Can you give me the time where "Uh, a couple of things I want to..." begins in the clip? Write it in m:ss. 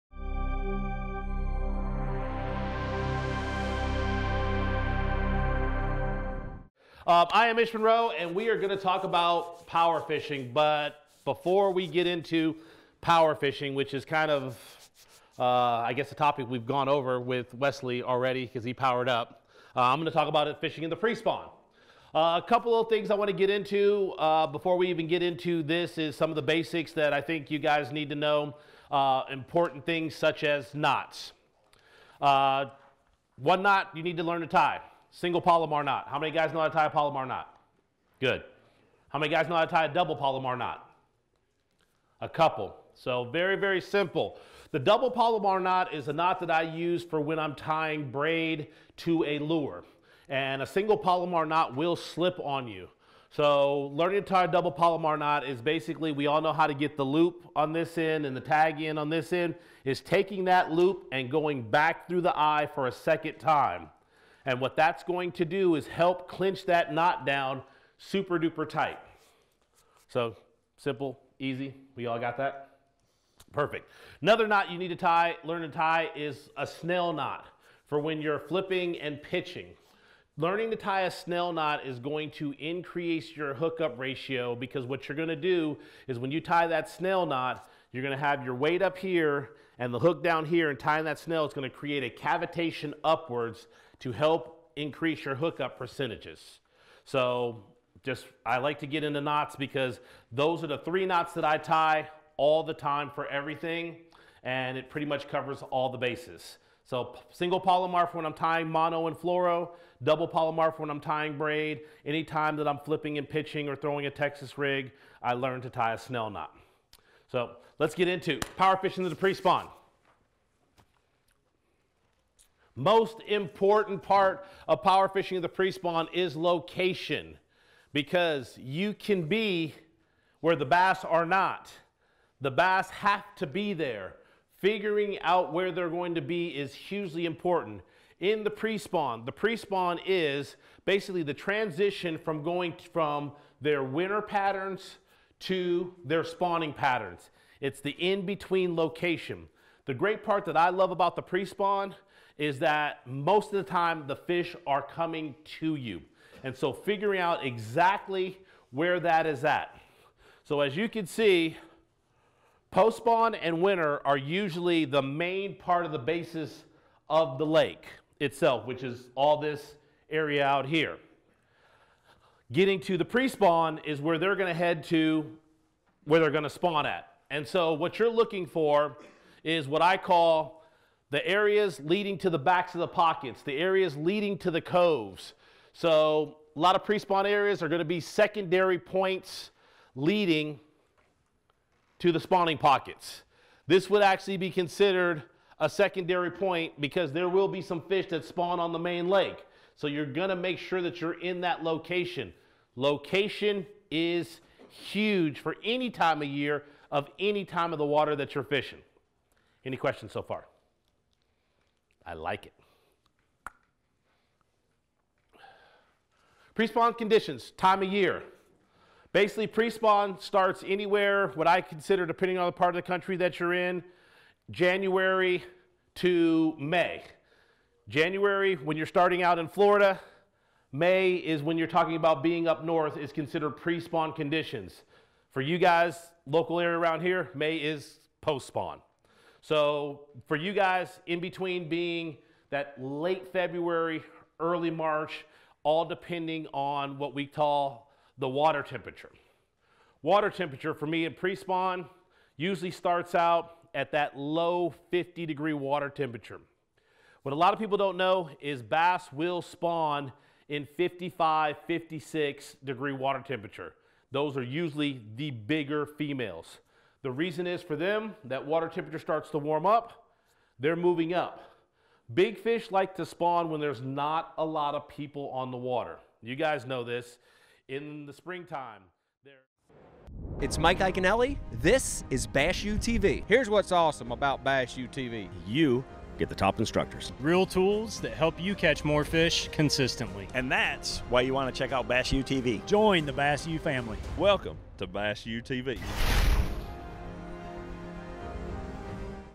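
0:22.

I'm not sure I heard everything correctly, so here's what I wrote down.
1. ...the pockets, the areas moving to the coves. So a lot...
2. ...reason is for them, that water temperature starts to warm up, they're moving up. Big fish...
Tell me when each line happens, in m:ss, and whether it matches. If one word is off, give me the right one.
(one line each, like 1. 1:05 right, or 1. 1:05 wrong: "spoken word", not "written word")
1. 3:02 wrong: "leading", not "moving"
2. 4:27 right.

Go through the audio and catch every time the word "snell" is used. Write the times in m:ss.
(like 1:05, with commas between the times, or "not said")
1:16, 1:21, 1:26, 1:31, 1:55.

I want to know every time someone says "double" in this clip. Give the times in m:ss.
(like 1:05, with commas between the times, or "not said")
0:39, 0:44, 0:54, 1:50.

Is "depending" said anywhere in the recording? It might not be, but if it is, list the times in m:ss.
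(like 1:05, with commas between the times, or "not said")
3:42, 4:05.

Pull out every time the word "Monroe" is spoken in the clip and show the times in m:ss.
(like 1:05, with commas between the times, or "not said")
0:07.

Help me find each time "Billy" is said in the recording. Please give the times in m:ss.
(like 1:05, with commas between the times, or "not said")
not said.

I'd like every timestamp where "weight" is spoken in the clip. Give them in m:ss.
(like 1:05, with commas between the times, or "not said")
1:28.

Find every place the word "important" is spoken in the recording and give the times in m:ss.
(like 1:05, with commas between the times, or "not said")
0:29, 2:03, 2:17.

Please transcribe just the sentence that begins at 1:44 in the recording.
And it pretty much covers all the bases.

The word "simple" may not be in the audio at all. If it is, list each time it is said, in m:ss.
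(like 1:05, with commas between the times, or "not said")
0:43, 1:10.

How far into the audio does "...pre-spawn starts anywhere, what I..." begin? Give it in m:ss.
3:39.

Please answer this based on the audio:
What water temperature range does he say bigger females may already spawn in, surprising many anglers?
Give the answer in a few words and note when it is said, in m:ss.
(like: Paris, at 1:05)
55 to 56 degrees, at 4:20.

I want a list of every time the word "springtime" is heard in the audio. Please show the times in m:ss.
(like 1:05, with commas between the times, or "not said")
4:38.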